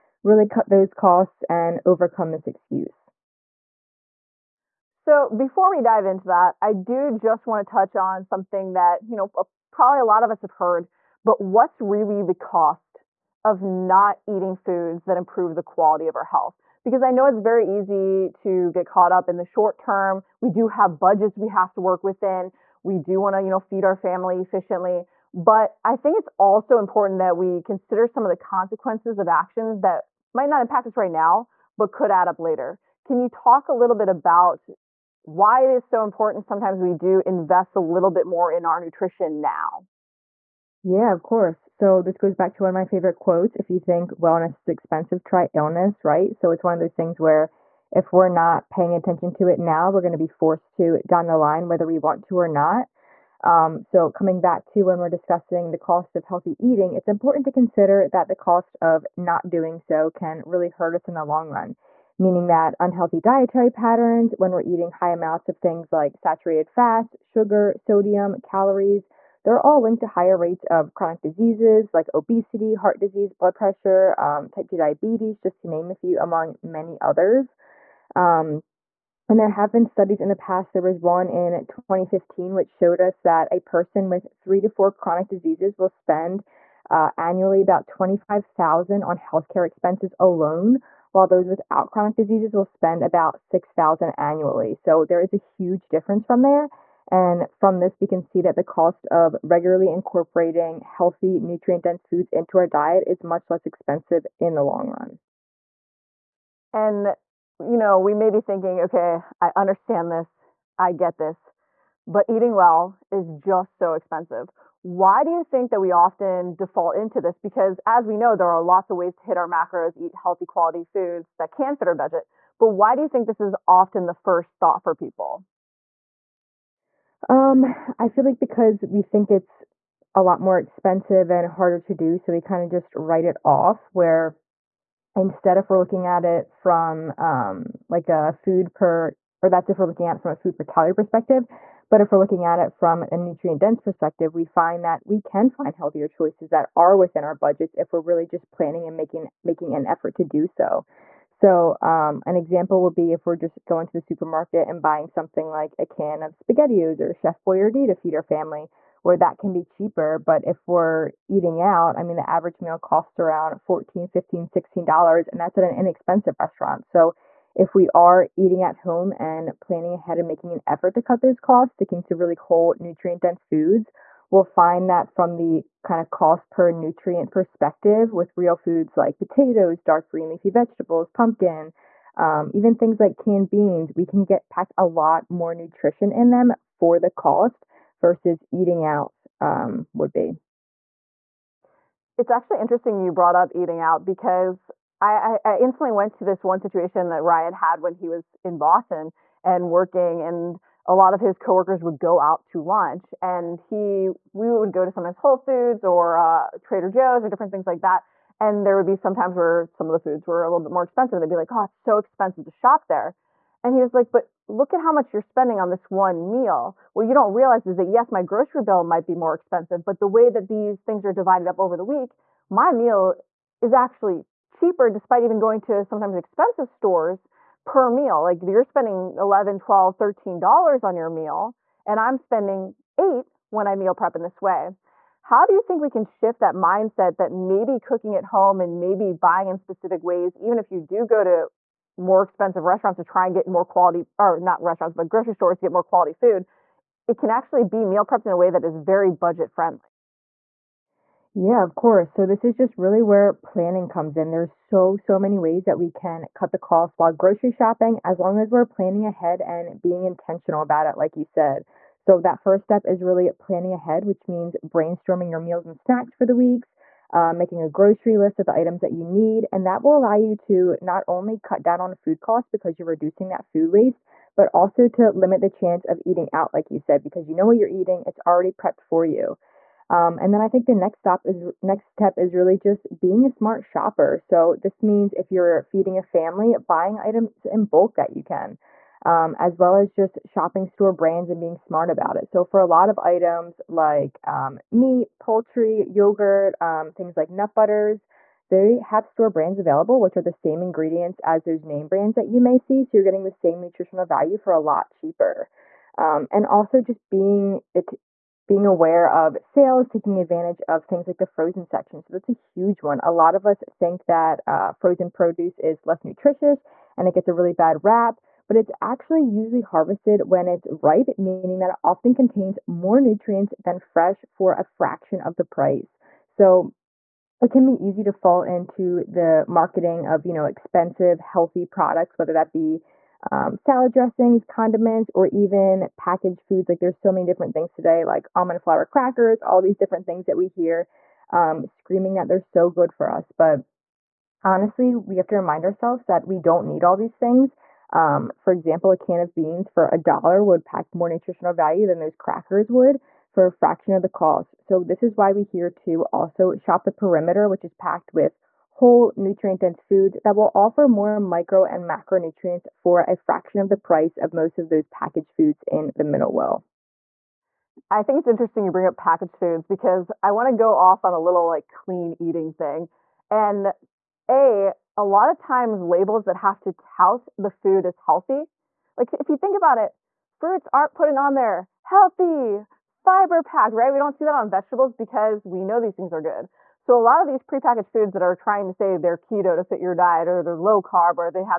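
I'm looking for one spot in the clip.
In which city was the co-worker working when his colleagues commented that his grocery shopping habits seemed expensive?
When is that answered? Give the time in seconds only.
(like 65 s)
198 s.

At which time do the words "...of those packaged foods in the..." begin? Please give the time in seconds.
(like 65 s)
364 s.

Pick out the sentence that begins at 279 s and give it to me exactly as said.
Um, and then I think the next stop is next step is really just being a smart shopper.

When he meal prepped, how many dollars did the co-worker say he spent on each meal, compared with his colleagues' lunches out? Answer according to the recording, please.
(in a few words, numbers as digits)
8.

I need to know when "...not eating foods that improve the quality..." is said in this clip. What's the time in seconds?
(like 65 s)
13 s.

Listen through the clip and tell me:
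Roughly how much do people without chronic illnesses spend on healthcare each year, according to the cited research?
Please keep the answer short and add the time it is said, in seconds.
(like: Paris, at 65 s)
6,000, at 93 s.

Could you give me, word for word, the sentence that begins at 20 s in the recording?
We do have budgets we have to work within.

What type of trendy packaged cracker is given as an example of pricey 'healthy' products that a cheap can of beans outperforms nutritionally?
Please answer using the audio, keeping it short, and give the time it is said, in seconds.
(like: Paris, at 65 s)
almond flour crackers, at 338 s.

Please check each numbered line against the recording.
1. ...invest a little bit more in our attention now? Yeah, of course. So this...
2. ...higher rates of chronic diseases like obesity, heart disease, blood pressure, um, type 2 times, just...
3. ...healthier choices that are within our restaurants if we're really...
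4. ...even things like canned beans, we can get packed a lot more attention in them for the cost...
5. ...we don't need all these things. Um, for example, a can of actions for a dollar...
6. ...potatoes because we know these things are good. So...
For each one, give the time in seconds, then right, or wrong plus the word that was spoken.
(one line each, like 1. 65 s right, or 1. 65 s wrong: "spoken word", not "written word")
1. 37 s wrong: "nutrition", not "attention"
2. 70 s wrong: "diabetes", not "times"
3. 145 s wrong: "budgets", not "restaurants"
4. 182 s wrong: "nutrition", not "attention"
5. 346 s wrong: "beans", not "actions"
6. 384 s wrong: "vegetables", not "potatoes".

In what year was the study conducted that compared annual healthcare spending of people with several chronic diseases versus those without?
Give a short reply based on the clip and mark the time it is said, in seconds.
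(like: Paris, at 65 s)
2015, at 81 s.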